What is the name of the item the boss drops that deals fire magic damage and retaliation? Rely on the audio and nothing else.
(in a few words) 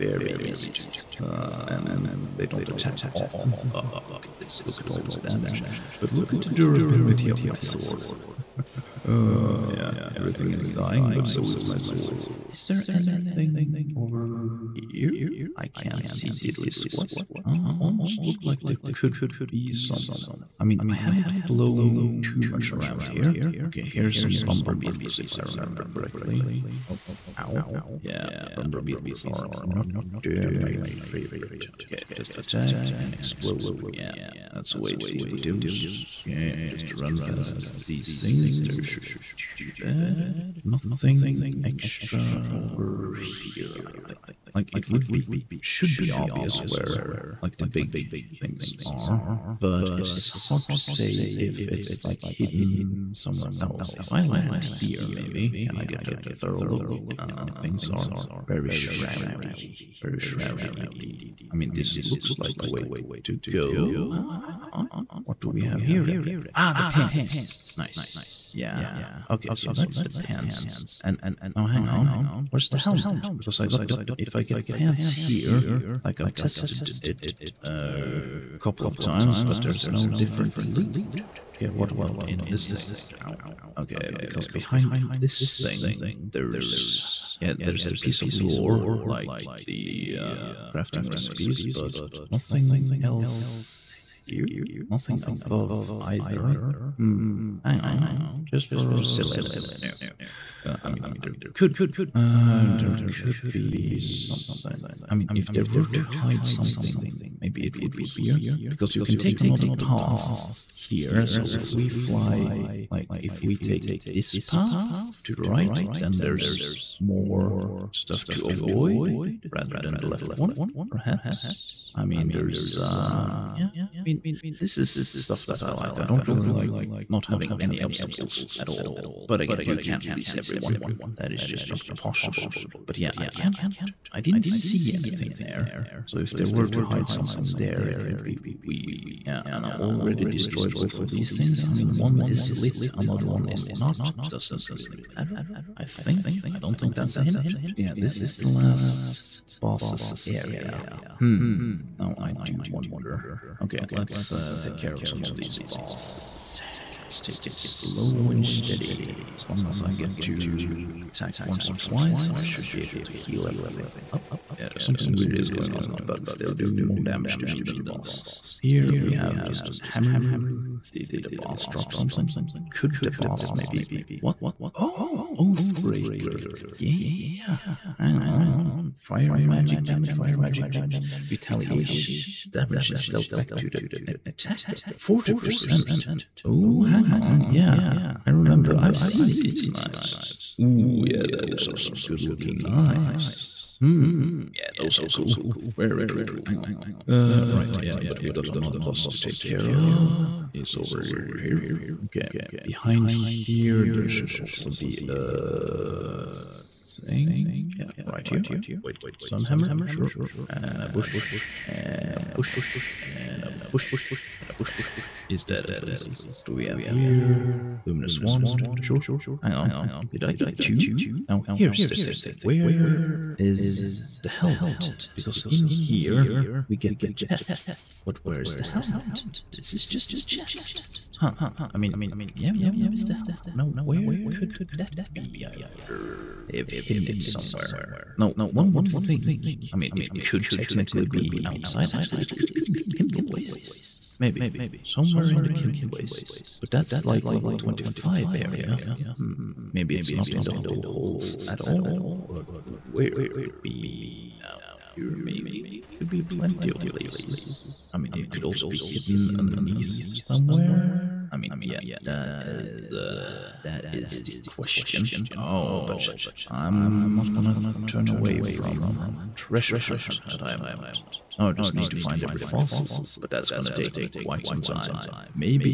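Oathbreaker.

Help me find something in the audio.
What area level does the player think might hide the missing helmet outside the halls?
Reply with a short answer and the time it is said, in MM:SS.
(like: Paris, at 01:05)
25, at 04:07.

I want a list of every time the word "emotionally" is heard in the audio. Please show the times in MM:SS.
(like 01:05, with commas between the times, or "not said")
not said.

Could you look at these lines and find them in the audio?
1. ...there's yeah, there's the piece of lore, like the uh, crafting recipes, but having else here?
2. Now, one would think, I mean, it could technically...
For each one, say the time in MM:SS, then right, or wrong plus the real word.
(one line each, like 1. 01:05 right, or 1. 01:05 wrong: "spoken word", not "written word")
1. 01:26 wrong: "nothing", not "having"
2. 03:58 right.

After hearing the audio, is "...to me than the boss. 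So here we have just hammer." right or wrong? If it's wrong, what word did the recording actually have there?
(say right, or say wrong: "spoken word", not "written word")
right.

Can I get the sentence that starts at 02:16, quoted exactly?
So if there were to hide something there, it would be weird.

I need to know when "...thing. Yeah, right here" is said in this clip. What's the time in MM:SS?
03:26.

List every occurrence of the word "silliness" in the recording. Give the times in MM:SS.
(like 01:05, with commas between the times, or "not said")
01:39.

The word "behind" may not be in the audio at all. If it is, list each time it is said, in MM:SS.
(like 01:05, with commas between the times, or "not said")
01:24, 03:22.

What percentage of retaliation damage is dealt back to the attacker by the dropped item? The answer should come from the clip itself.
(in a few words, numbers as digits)
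40%.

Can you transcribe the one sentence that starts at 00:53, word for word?
If I land here, maybe, can I get a thorough look?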